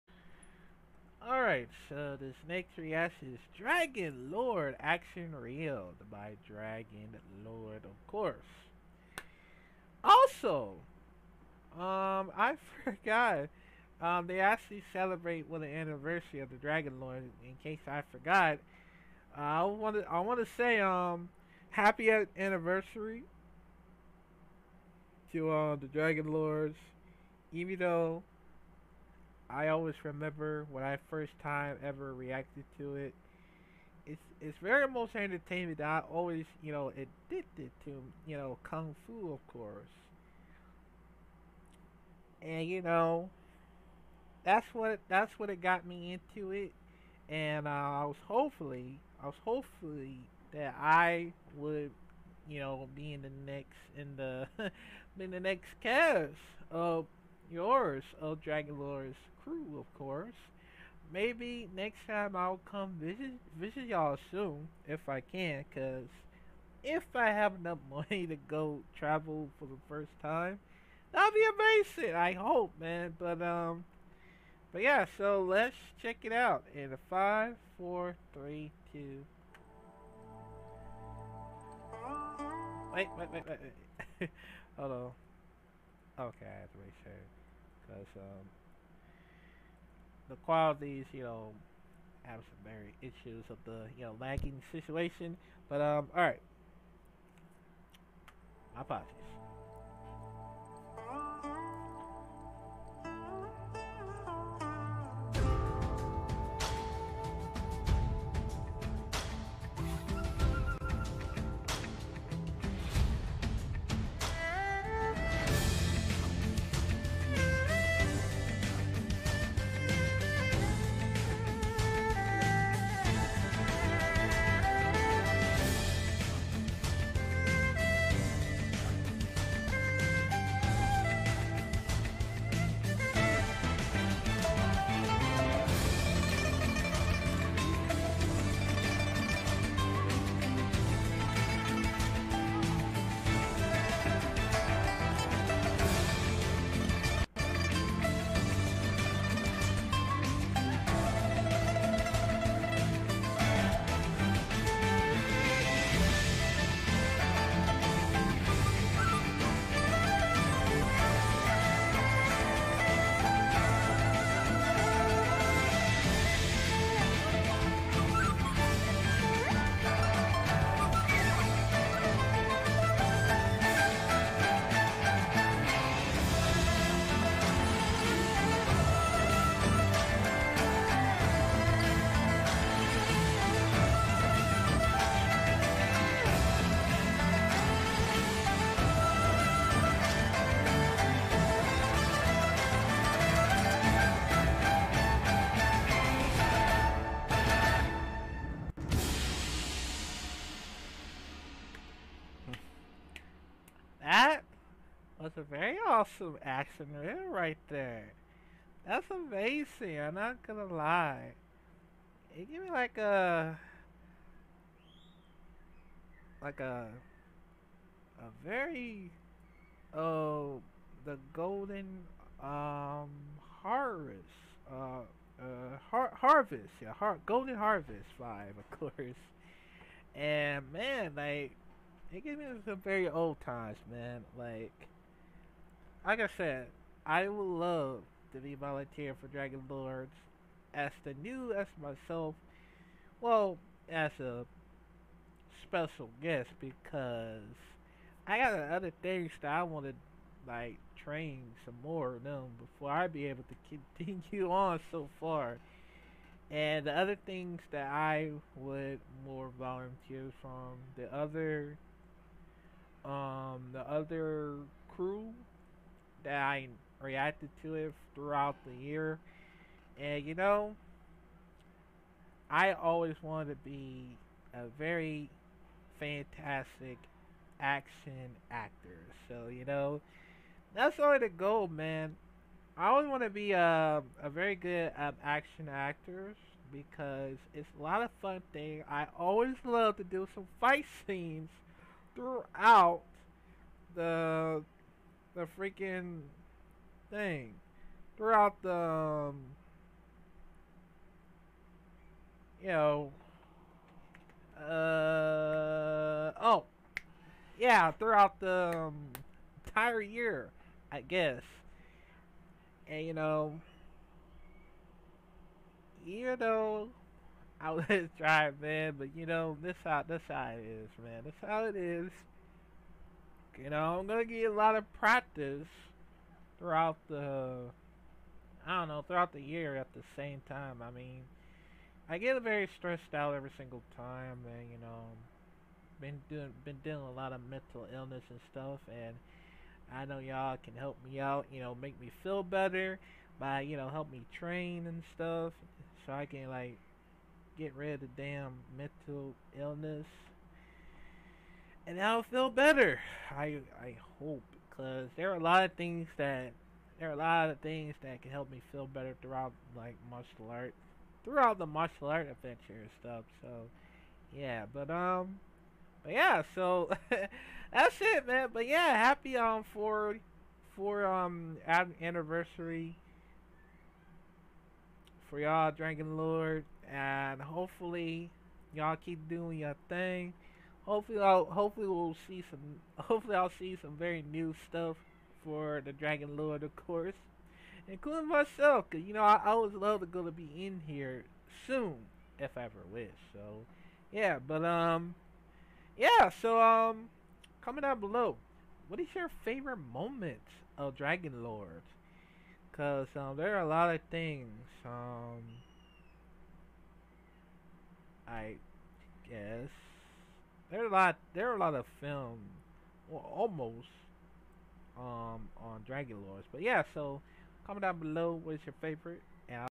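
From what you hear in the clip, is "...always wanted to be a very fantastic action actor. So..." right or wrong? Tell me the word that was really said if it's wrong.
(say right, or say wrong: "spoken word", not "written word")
right.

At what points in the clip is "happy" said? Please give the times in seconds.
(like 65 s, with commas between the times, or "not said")
21 s, 368 s.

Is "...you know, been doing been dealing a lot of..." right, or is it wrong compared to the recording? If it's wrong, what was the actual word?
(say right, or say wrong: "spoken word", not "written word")
right.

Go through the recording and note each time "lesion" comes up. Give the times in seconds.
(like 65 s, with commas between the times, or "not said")
not said.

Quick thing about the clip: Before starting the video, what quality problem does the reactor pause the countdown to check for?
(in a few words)
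lagging.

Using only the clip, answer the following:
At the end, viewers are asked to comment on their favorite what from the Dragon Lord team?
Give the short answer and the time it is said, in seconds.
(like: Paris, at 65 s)
moment, at 399 s.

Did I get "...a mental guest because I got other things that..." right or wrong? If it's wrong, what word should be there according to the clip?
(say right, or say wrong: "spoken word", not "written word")
wrong: "special", not "mental".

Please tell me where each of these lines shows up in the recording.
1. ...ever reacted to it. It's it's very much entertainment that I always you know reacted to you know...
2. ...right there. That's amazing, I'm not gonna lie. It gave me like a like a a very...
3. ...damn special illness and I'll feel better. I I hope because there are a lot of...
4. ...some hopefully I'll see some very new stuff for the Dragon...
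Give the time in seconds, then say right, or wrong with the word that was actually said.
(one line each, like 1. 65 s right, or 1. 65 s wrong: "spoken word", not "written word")
1. 31 s wrong: "addicted", not "reacted"
2. 207 s right
3. 348 s wrong: "mental", not "special"
4. 382 s right.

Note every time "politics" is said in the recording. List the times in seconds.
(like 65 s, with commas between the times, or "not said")
not said.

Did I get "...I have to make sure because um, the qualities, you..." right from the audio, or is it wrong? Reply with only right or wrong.
right.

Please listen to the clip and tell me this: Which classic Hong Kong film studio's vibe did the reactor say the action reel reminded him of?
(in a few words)
Golden Harvest.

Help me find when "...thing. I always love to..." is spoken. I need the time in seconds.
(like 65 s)
288 s.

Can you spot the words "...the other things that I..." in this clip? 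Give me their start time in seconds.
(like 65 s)
256 s.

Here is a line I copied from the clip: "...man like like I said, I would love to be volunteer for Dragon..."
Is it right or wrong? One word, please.
right.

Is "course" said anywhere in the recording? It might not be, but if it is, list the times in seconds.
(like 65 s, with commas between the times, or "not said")
8 s, 39 s, 59 s, 228 s, 386 s.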